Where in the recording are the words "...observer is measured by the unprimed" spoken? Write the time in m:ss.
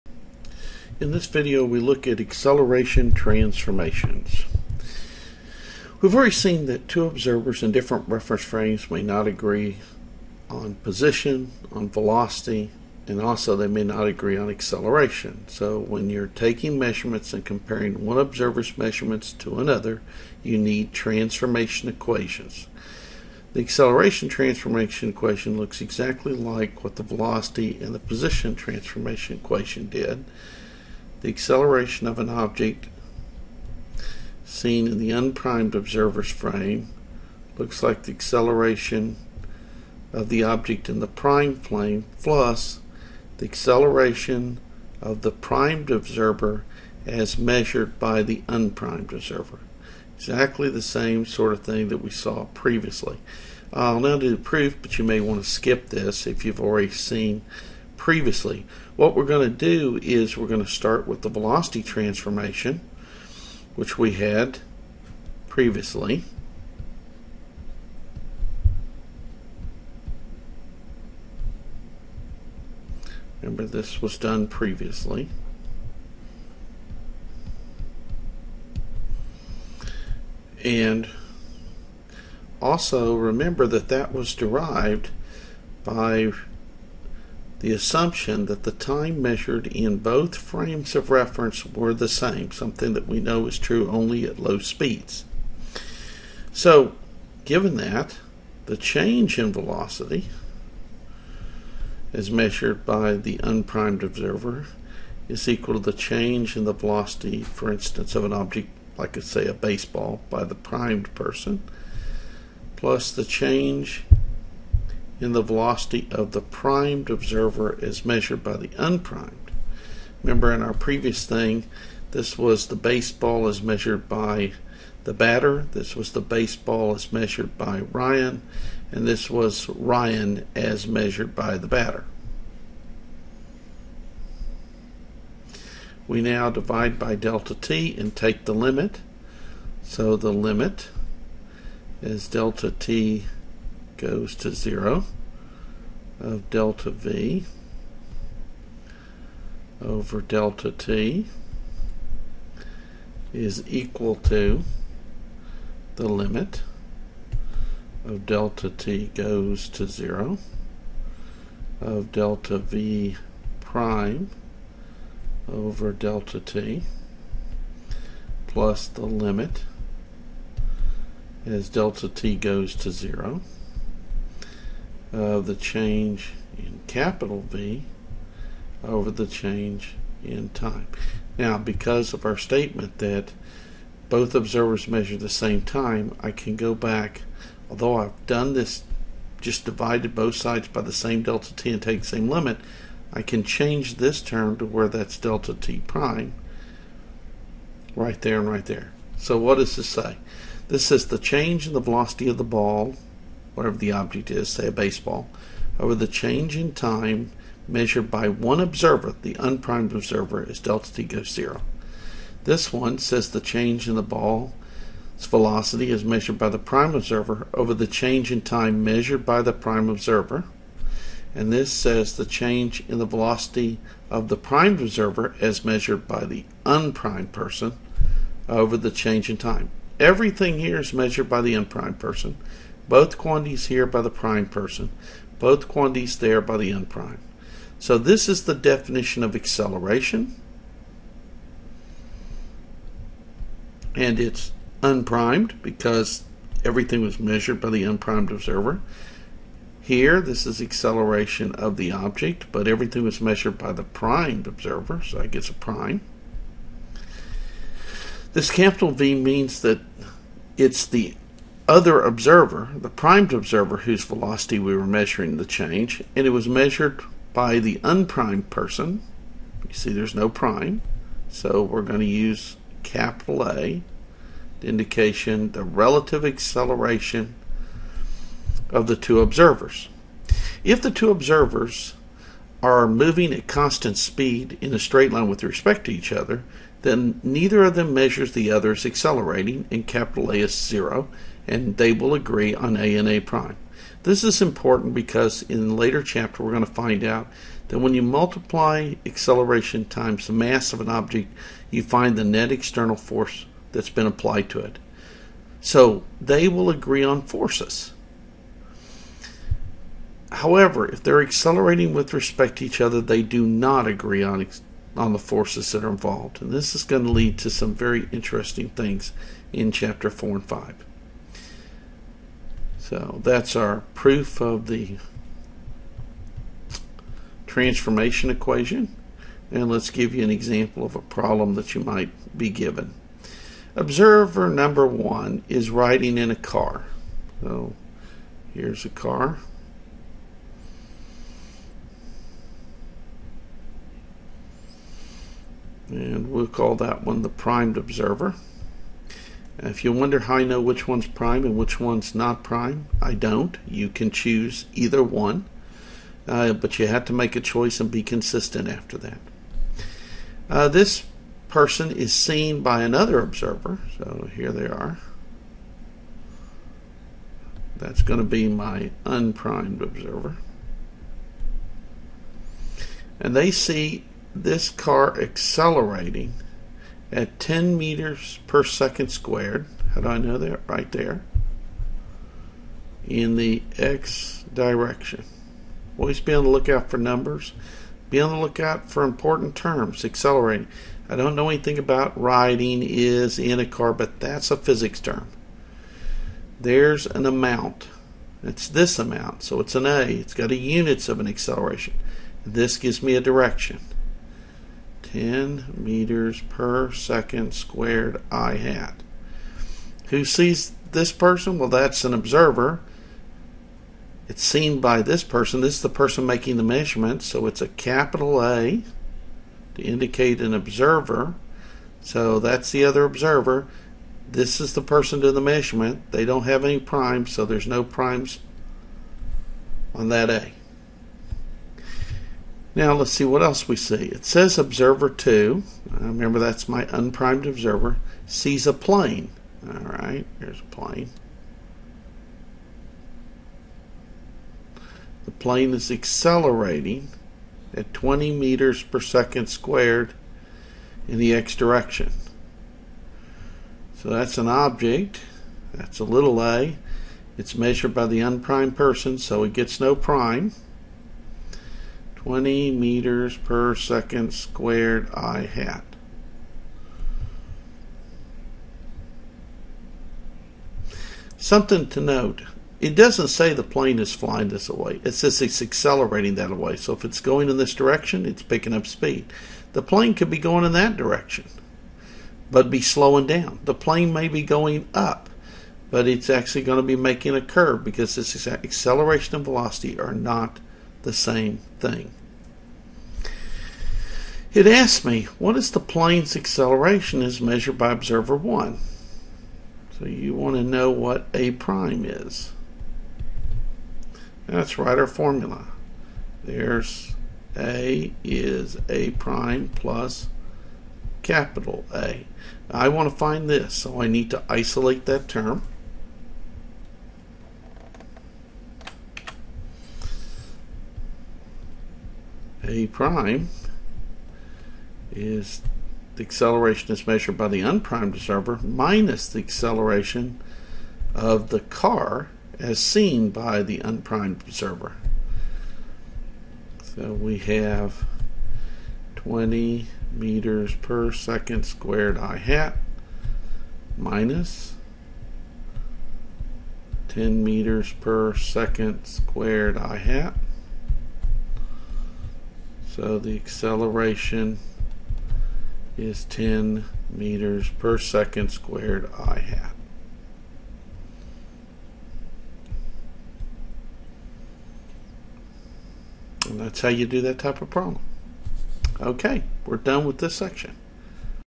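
1:57.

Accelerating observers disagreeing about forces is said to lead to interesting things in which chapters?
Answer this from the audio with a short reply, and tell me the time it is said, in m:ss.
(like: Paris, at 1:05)
4 and 5, at 5:19.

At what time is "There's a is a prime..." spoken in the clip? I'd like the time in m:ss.
8:26.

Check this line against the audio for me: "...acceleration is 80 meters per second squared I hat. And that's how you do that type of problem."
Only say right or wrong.
wrong.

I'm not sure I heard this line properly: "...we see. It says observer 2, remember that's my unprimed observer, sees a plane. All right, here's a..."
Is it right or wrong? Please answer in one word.
right.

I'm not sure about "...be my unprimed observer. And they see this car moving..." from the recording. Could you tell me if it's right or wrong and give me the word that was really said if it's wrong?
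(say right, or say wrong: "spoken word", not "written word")
wrong: "accelerating", not "moving".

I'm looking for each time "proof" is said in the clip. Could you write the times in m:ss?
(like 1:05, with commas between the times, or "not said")
0:54, 5:23.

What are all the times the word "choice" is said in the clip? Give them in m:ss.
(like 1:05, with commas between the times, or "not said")
5:57.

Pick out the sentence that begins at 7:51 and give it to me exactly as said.
Something to note, it doesn't say the plane is flying this away.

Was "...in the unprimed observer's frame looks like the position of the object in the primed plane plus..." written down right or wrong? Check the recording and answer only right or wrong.
wrong.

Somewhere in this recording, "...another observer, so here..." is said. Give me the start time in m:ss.
6:02.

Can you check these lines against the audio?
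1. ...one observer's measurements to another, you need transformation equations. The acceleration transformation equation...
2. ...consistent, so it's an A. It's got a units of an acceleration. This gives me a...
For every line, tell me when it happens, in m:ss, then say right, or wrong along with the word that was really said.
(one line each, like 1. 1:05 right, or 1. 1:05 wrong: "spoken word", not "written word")
1. 0:18 right
2. 6:38 wrong: "amount", not "consistent".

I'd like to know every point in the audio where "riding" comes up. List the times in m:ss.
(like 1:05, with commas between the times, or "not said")
5:35, 6:32.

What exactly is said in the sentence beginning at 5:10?
However, if they're accelerating with respect to each other, they do not agree on, on the forces that are involved.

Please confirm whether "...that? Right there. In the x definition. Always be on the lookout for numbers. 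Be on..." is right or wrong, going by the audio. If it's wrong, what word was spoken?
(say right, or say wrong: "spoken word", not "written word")
wrong: "direction", not "definition".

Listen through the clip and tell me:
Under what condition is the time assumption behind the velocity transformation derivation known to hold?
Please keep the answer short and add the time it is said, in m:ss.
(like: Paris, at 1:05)
low speeds, at 1:34.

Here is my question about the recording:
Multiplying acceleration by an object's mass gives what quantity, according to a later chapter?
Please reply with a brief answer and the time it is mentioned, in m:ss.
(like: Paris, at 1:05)
net external force, at 5:02.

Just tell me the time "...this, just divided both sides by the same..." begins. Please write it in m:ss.
3:08.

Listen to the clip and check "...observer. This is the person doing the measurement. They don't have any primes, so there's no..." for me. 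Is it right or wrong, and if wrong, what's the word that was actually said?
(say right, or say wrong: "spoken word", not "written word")
right.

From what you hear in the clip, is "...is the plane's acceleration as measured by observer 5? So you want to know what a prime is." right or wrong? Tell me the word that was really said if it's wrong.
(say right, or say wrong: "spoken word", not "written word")
wrong: "1", not "5".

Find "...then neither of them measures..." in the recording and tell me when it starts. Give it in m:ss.
4:46.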